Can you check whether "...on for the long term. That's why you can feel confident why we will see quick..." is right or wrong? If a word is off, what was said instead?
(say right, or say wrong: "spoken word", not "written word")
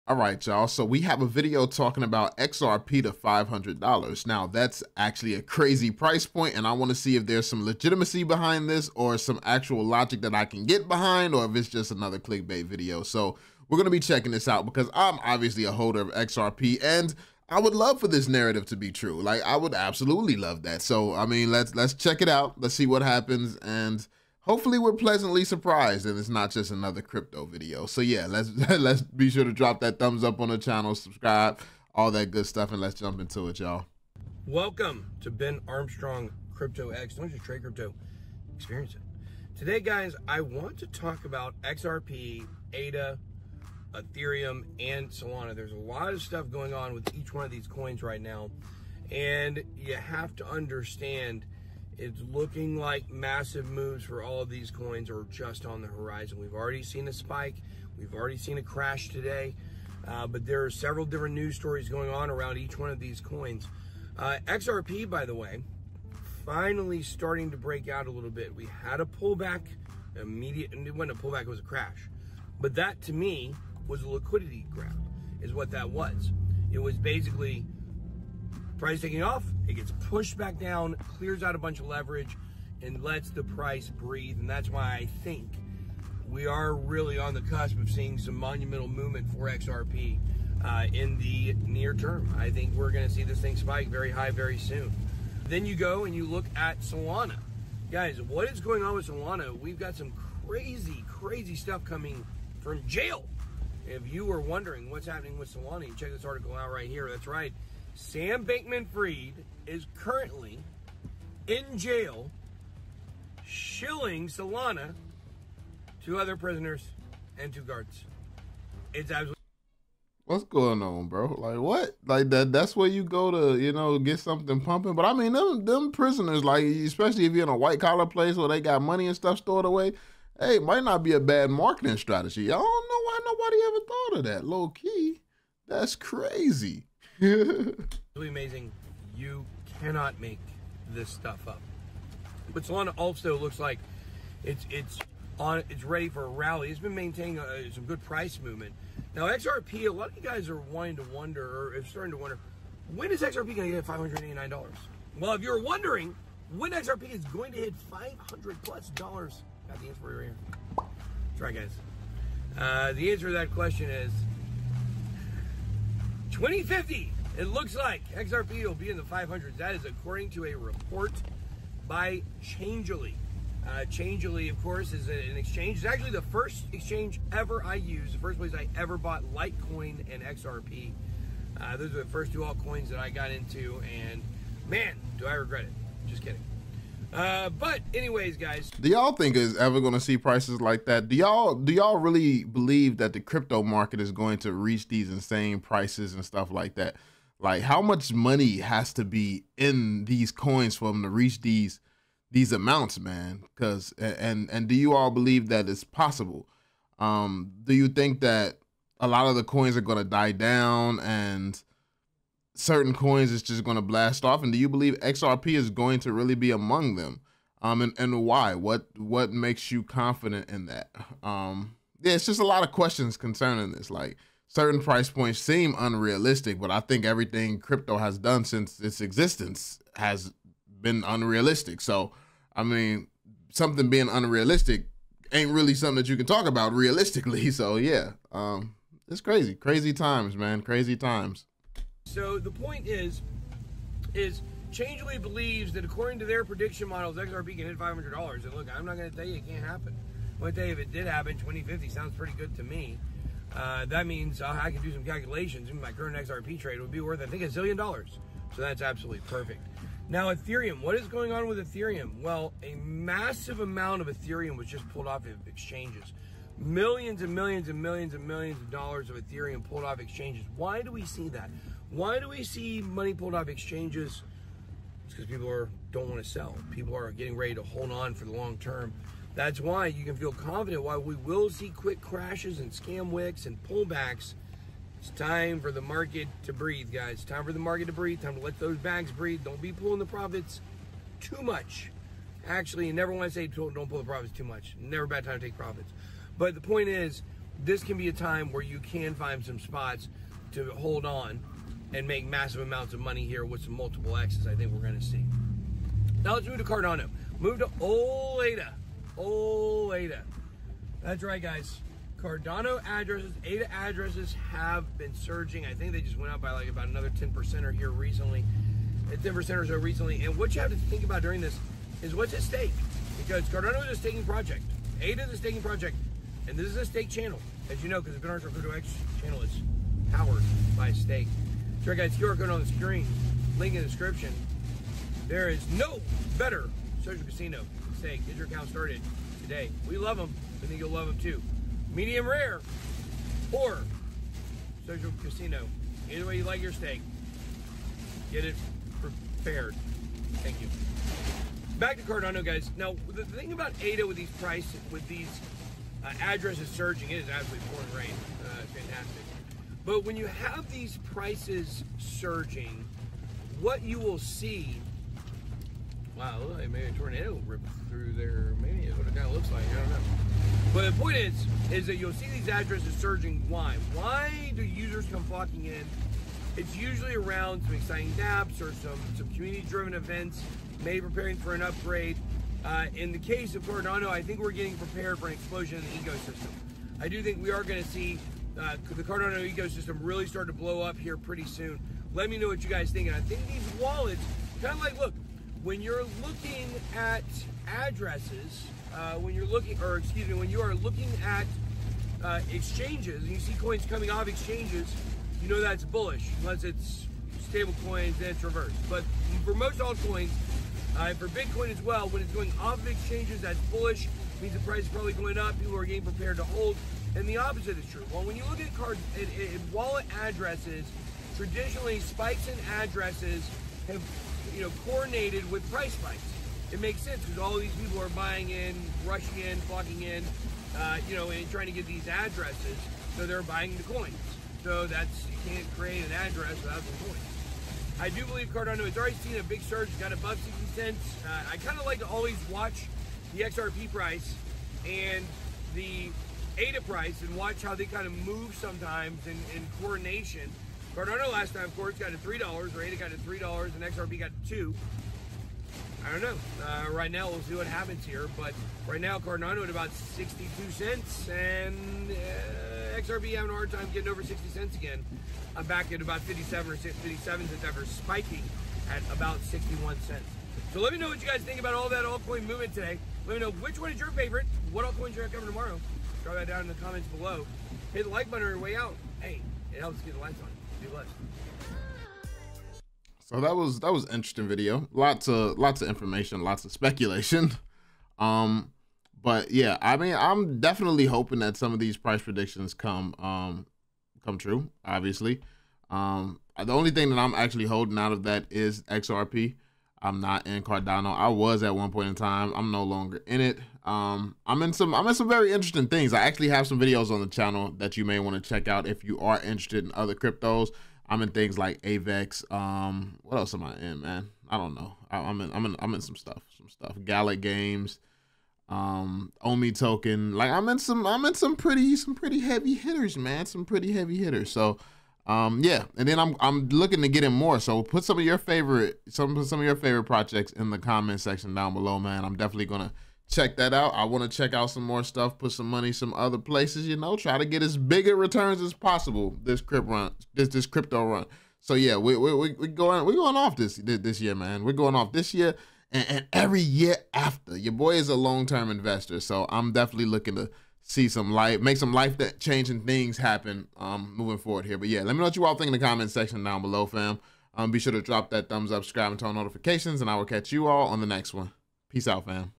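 right.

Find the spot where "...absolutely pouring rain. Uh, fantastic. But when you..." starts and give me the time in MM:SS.
05:57.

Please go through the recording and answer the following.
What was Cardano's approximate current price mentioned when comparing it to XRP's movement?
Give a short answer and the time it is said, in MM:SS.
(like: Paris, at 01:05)
62 cents, at 07:39.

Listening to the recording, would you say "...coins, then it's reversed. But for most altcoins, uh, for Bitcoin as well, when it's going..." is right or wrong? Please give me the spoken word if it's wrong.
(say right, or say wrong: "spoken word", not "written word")
right.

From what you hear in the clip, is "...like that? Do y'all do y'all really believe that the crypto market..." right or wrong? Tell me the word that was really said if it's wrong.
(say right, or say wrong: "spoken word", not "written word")
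right.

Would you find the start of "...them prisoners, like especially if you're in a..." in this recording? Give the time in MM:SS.
02:05.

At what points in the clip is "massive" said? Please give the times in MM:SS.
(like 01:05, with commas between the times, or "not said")
00:53, 04:22, 05:02.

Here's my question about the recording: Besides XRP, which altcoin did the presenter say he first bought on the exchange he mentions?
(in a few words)
Litecoin.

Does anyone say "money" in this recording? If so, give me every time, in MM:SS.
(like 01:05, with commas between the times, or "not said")
02:08, 03:18, 04:32, 05:02, 08:55.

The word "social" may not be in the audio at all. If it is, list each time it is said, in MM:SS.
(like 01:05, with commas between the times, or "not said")
05:37, 05:44.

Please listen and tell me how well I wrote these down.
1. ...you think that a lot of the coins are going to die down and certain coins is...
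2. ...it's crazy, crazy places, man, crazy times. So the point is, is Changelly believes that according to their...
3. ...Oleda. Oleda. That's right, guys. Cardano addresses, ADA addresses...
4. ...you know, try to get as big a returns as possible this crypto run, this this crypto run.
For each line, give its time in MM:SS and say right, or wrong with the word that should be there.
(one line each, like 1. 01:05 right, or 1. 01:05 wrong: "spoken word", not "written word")
1. 03:27 right
2. 03:59 wrong: "times", not "places"
3. 05:07 right
4. 08:56 right.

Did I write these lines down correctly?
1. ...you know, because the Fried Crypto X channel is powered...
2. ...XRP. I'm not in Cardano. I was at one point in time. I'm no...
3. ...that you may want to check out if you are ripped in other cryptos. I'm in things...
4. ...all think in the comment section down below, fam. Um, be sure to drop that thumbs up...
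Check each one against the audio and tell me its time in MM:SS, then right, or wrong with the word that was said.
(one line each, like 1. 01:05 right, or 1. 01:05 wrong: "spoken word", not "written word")
1. 05:27 wrong: "Binance", not "Fried"
2. 08:18 right
3. 08:27 wrong: "interested", not "ripped"
4. 09:15 right.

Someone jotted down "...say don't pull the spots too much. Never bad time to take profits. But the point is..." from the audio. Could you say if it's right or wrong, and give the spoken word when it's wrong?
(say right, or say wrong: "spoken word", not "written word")
wrong: "profits", not "spots".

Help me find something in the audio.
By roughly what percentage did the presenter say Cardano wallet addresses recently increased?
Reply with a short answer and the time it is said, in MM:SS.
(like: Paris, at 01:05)
10%, at 05:19.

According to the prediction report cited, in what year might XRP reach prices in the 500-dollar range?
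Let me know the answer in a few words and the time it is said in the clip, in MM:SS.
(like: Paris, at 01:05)
2050, at 02:42.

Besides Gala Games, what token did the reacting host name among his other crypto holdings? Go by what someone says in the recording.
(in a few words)
Omi Token.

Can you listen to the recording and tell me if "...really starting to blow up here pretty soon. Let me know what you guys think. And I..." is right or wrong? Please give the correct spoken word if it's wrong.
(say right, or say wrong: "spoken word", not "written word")
right.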